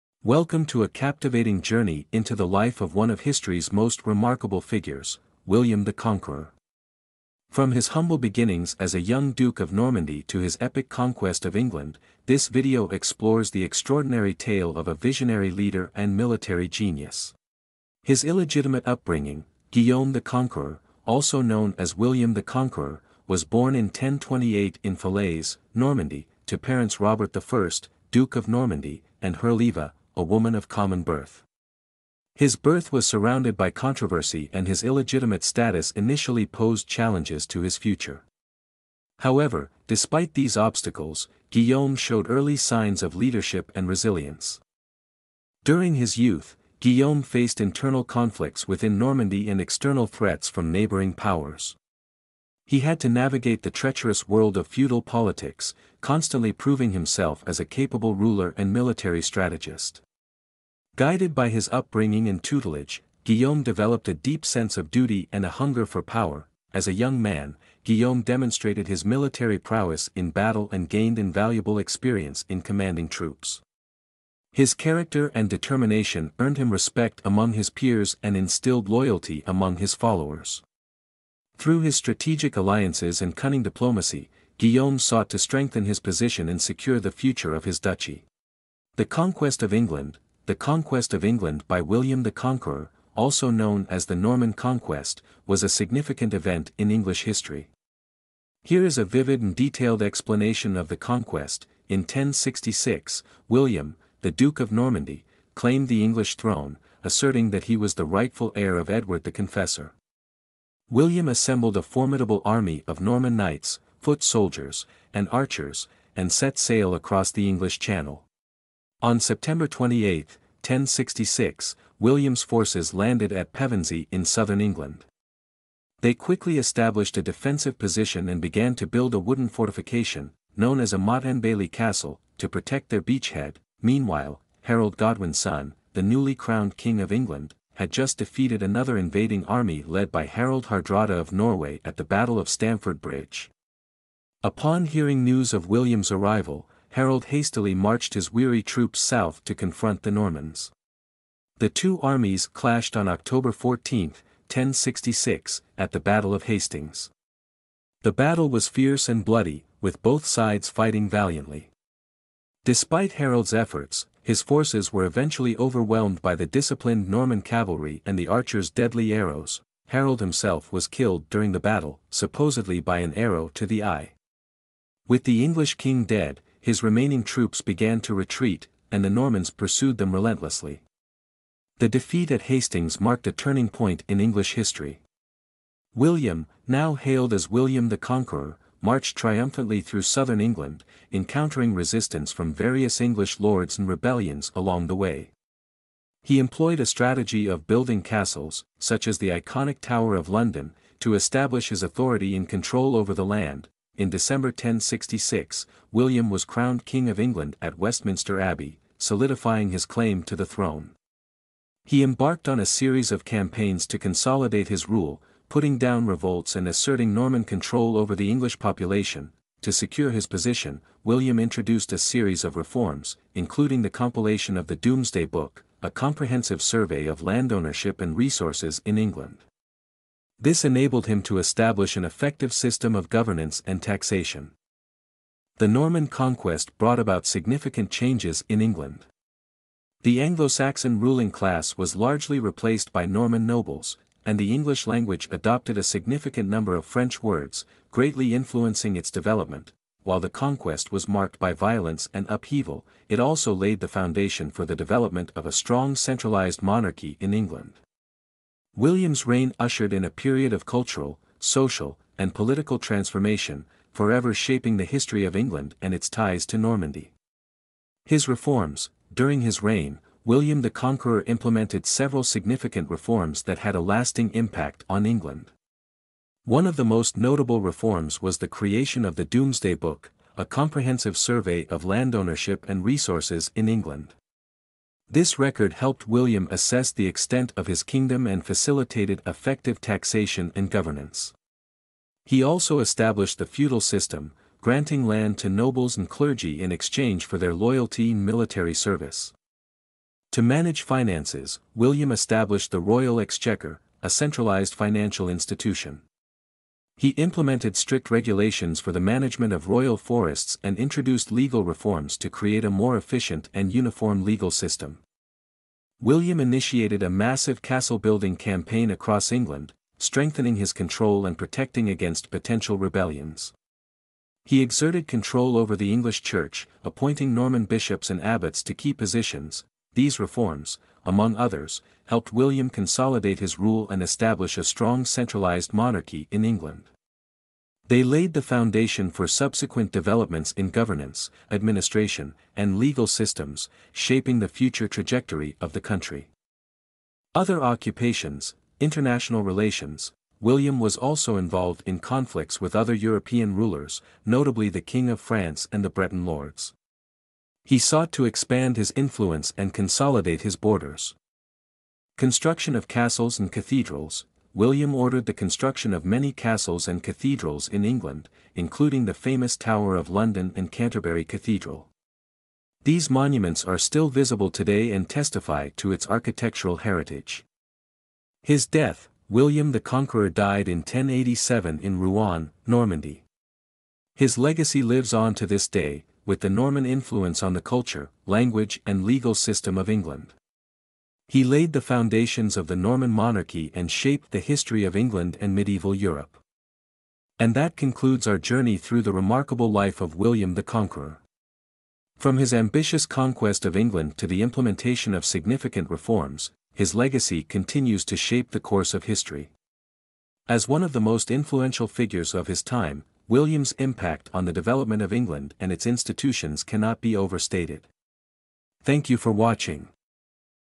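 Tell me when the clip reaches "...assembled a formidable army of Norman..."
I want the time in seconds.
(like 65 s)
111 s.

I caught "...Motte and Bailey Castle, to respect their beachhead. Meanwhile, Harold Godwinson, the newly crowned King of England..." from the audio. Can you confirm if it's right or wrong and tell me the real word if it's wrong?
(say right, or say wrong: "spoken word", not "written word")
wrong: "protect", not "respect".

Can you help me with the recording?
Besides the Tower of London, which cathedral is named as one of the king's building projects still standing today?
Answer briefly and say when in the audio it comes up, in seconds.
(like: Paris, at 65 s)
Canterbury Cathedral, at 370 s.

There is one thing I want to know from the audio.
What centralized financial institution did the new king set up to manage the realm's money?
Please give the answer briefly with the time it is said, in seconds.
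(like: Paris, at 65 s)
Royal Exchequer, at 302 s.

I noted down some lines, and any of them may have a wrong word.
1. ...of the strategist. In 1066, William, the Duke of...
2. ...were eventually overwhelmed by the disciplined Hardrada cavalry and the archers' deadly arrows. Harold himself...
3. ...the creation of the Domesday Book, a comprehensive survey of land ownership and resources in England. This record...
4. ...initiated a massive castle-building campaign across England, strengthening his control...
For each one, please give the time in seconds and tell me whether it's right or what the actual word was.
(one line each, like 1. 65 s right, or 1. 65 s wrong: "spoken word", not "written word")
1. 100 s wrong: "conquest", not "strategist"
2. 164 s wrong: "Norman", not "Hardrada"
3. 278 s right
4. 316 s right.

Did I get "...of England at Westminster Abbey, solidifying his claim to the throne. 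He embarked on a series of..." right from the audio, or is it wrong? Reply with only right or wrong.
right.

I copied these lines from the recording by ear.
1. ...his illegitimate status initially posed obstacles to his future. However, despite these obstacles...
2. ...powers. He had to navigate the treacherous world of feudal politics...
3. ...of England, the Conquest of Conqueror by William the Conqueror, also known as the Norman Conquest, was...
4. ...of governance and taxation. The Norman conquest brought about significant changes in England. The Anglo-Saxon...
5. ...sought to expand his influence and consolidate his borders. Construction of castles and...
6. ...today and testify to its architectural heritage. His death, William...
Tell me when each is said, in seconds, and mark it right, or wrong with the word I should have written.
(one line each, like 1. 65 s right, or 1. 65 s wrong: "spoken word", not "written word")
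1. 34 s wrong: "challenges", not "obstacles"
2. 51 s right
3. 89 s wrong: "England", not "Conqueror"
4. 232 s right
5. 357 s right
6. 374 s right.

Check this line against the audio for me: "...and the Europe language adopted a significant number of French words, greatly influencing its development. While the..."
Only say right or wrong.
wrong.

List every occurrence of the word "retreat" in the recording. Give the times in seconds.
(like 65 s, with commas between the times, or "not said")
178 s.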